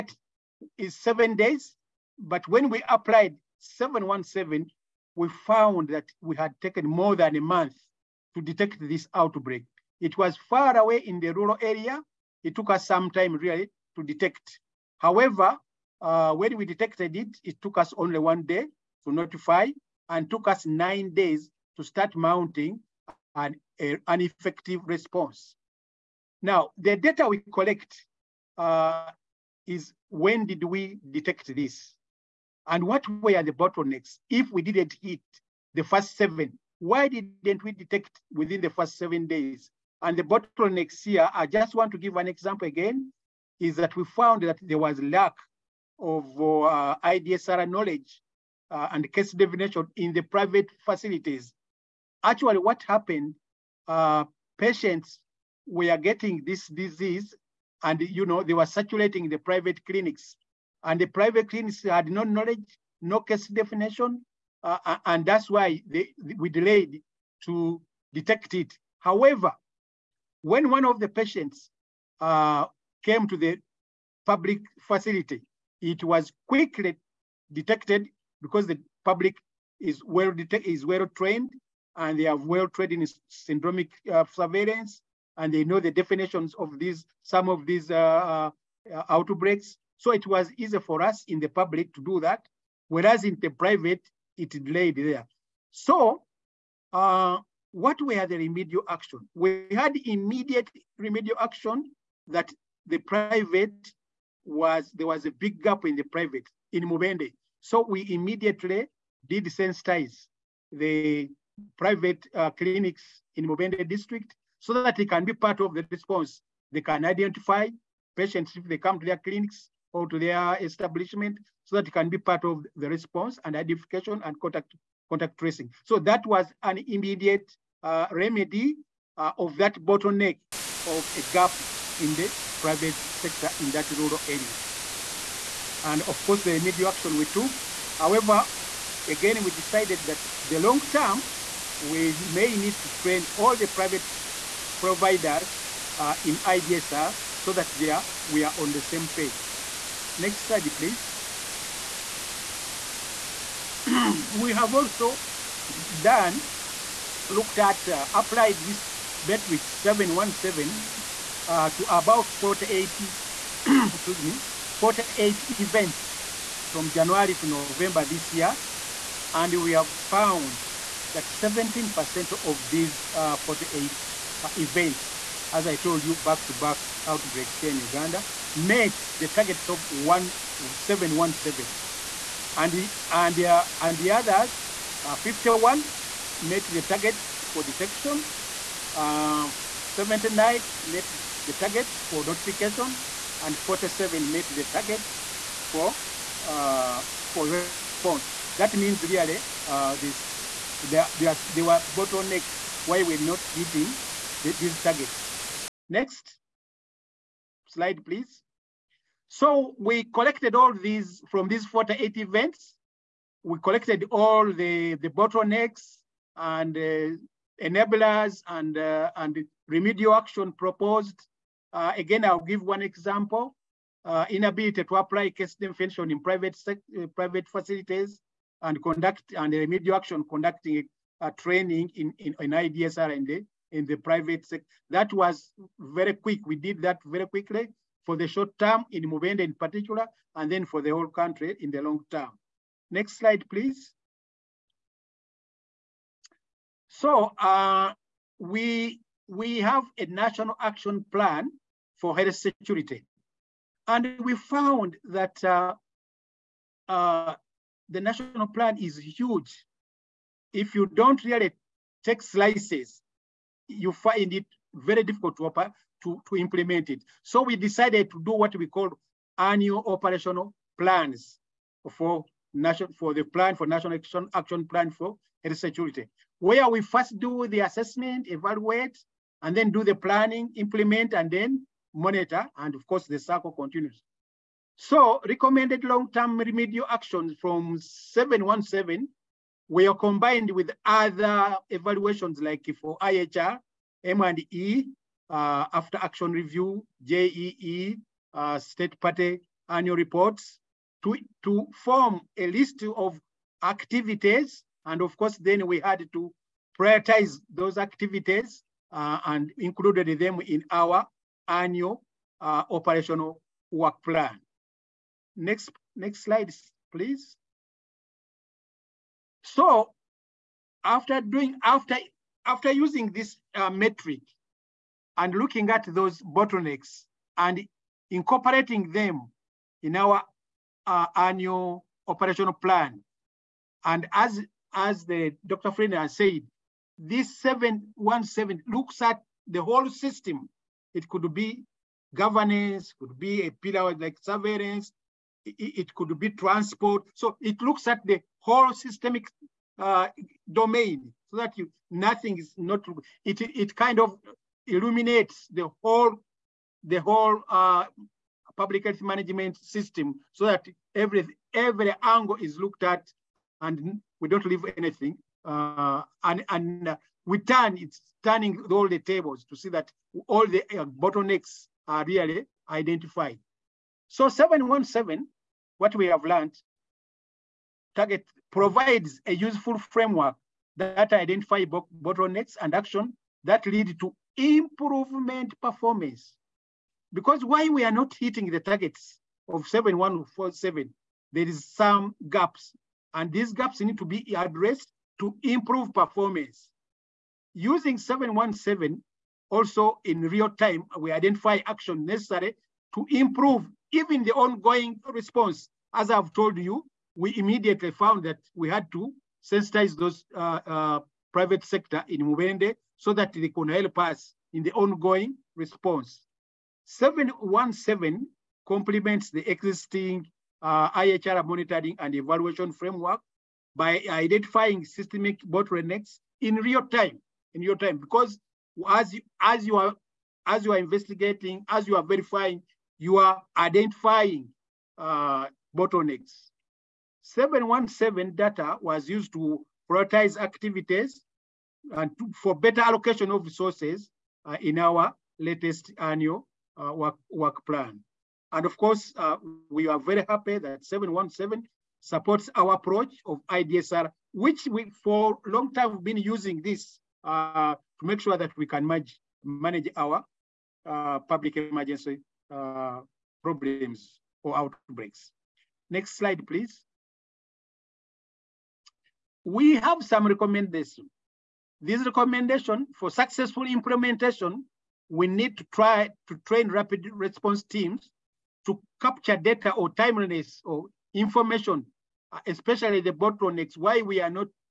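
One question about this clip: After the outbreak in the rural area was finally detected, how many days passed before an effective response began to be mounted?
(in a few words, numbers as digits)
9 days.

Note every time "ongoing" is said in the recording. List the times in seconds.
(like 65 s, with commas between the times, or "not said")
404 s, 414 s.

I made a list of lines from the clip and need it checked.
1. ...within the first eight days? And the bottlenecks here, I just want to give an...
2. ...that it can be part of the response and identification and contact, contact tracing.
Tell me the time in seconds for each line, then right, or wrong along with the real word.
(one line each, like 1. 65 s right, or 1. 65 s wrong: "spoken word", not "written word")
1. 38 s wrong: "seven", not "eight"
2. 121 s right.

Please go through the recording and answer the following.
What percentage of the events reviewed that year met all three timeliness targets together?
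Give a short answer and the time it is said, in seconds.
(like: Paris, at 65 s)
17%, at 171 s.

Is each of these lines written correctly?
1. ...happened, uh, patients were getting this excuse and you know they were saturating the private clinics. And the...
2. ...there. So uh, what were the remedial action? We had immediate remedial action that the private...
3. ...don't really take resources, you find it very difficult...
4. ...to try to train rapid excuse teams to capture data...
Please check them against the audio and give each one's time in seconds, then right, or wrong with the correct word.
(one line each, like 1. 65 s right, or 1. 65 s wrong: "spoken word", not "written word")
1. 52 s wrong: "disease", not "excuse"
2. 94 s right
3. 260 s wrong: "slices", not "resources"
4. 475 s wrong: "response", not "excuse".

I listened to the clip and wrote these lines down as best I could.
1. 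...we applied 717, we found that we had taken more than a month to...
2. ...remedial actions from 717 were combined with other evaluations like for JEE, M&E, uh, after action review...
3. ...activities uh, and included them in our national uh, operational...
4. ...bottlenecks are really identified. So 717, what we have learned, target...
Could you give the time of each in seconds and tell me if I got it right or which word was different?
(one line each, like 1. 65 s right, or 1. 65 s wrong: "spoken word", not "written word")
1. 2 s right
2. 286 s wrong: "IHR", not "JEE"
3. 307 s wrong: "annual", not "national"
4. 370 s right.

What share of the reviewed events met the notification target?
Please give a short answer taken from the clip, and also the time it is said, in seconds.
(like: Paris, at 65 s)
79, at 189 s.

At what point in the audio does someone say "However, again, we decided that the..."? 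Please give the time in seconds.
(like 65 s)
137 s.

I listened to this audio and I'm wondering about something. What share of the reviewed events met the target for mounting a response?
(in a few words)
47.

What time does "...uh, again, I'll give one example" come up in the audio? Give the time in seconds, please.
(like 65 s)
221 s.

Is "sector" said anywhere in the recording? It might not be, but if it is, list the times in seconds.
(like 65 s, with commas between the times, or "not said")
133 s, 234 s, 411 s.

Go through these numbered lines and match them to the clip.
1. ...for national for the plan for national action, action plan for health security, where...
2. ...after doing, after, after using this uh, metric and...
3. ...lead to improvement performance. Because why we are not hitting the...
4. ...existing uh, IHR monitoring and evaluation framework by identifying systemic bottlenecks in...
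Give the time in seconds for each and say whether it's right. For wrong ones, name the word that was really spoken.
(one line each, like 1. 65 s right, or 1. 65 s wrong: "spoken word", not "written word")
1. 271 s right
2. 320 s right
3. 383 s right
4. 419 s right.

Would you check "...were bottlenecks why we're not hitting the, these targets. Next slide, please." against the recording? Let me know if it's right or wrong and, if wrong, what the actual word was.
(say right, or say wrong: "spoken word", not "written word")
right.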